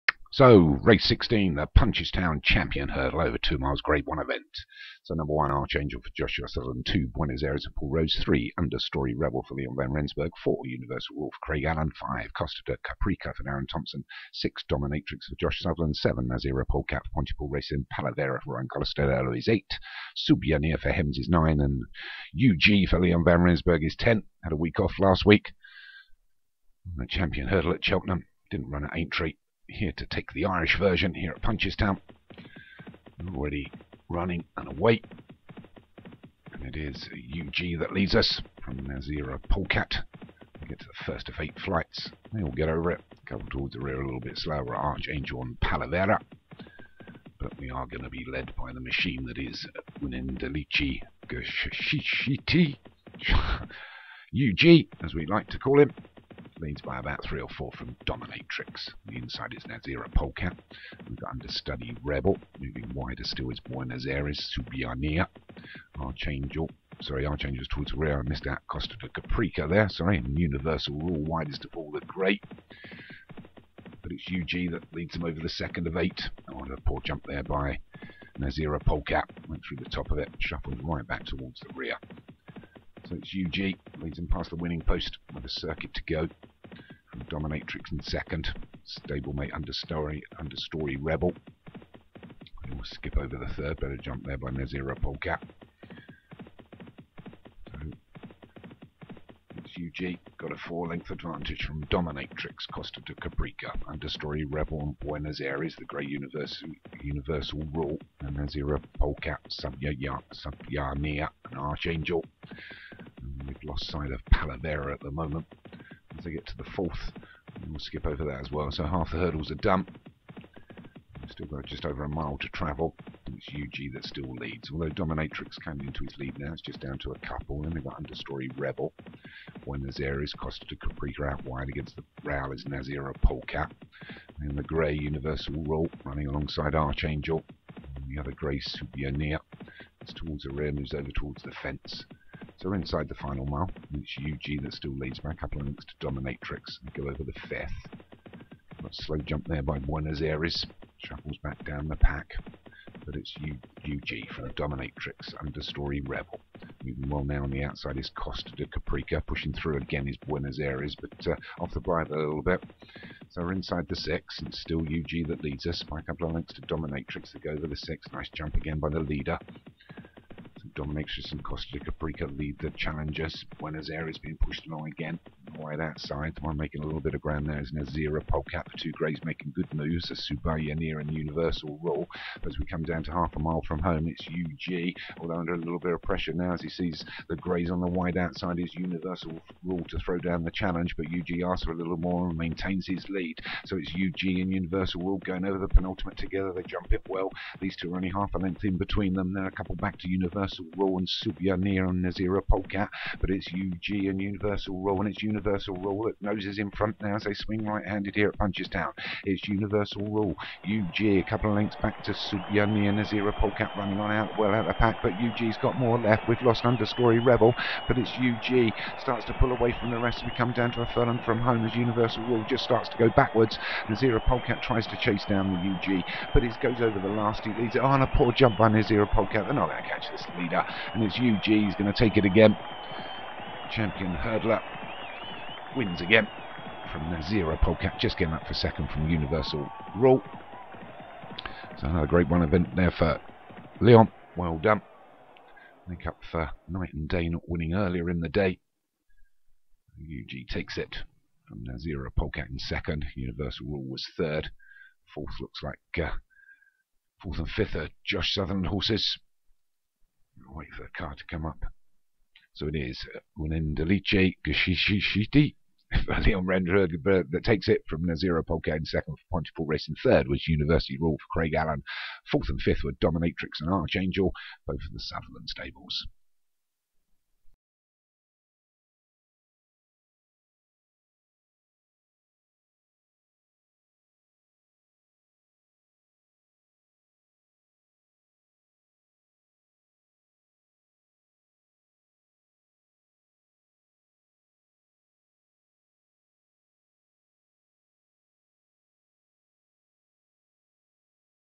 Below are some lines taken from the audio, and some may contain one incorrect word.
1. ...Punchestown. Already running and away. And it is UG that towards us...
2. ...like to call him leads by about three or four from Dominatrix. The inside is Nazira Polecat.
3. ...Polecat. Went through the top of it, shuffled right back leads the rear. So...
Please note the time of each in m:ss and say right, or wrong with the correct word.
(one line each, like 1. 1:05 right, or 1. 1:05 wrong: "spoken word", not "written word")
1. 0:31 wrong: "leads", not "towards"
2. 0:55 right
3. 1:18 wrong: "towards", not "leads".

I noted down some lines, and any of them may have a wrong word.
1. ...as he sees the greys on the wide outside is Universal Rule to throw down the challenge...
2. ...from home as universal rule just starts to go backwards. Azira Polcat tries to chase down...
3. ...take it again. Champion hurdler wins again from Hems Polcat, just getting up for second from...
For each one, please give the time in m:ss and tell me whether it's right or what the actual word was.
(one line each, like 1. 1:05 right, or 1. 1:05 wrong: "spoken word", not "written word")
1. 3:06 right
2. 3:41 right
3. 3:51 wrong: "Nazira", not "Hems".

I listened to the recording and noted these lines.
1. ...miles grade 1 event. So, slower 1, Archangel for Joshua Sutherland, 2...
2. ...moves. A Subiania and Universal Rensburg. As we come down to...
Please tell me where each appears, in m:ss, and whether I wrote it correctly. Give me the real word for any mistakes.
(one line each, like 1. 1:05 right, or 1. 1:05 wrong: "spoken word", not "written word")
1. 0:03 wrong: "number", not "slower"
2. 2:59 wrong: "Rule", not "Rensburg".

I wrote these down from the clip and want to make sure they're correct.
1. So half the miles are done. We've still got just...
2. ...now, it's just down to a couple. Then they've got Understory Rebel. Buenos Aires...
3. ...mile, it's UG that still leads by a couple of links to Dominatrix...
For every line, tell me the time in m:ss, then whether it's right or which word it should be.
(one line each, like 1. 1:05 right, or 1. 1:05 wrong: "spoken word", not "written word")
1. 1:58 wrong: "hurdles", not "miles"
2. 2:06 right
3. 2:23 right.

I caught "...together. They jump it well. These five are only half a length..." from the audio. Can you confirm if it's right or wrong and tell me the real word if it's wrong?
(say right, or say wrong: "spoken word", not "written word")
wrong: "two", not "five".